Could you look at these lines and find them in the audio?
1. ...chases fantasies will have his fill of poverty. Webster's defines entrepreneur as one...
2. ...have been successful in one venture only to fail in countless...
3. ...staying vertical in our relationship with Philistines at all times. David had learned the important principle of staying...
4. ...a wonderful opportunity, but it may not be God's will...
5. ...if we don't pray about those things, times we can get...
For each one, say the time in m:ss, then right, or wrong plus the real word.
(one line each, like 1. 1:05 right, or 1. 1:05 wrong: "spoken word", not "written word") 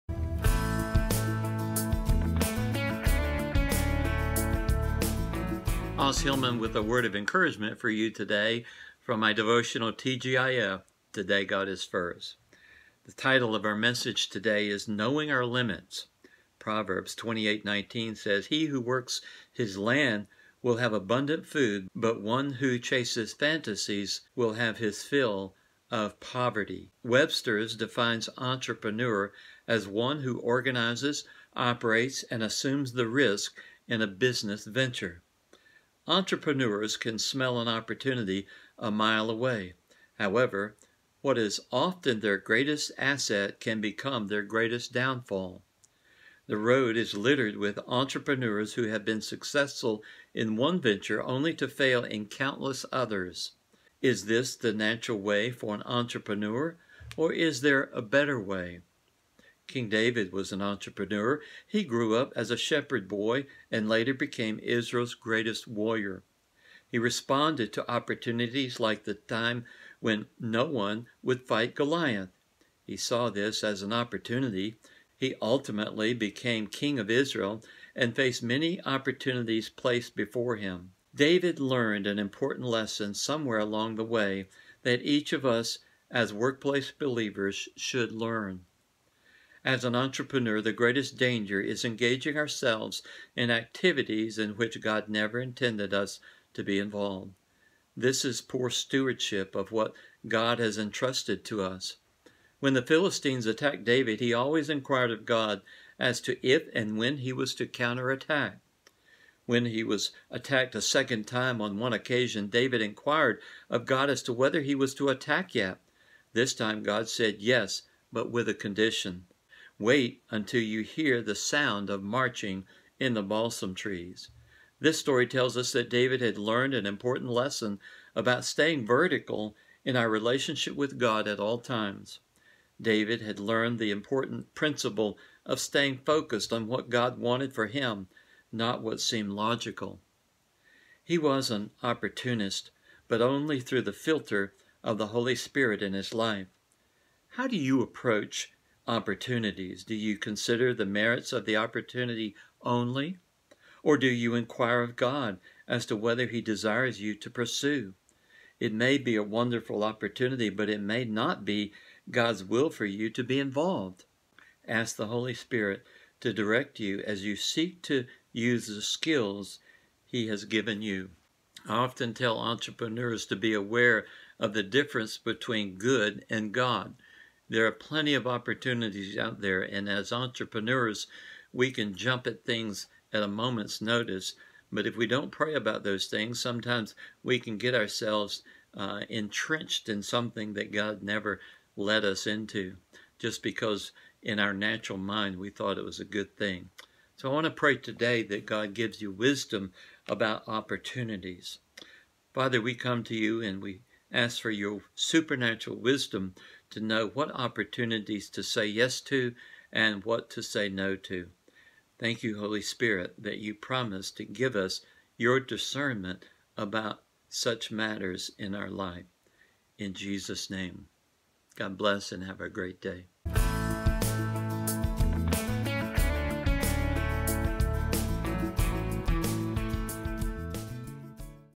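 1. 0:22 right
2. 0:48 right
3. 2:08 wrong: "God", not "Philistines"
4. 2:39 right
5. 3:04 wrong: "sometimes", not "times".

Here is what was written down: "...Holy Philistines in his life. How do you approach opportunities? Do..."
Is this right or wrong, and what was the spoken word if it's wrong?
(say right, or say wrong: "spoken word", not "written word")
wrong: "Spirit", not "Philistines".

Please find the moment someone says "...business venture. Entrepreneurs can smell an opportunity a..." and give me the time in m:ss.
0:34.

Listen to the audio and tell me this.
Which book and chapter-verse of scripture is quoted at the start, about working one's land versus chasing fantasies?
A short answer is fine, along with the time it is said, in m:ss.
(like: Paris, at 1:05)
Proverbs 28:19, at 0:16.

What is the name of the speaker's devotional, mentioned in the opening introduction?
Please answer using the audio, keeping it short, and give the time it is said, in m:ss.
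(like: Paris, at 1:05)
TGIF, at 0:09.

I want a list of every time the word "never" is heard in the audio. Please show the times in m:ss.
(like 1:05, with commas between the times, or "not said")
1:35, 3:11.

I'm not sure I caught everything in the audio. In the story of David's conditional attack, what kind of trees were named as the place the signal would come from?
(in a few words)
balsam trees.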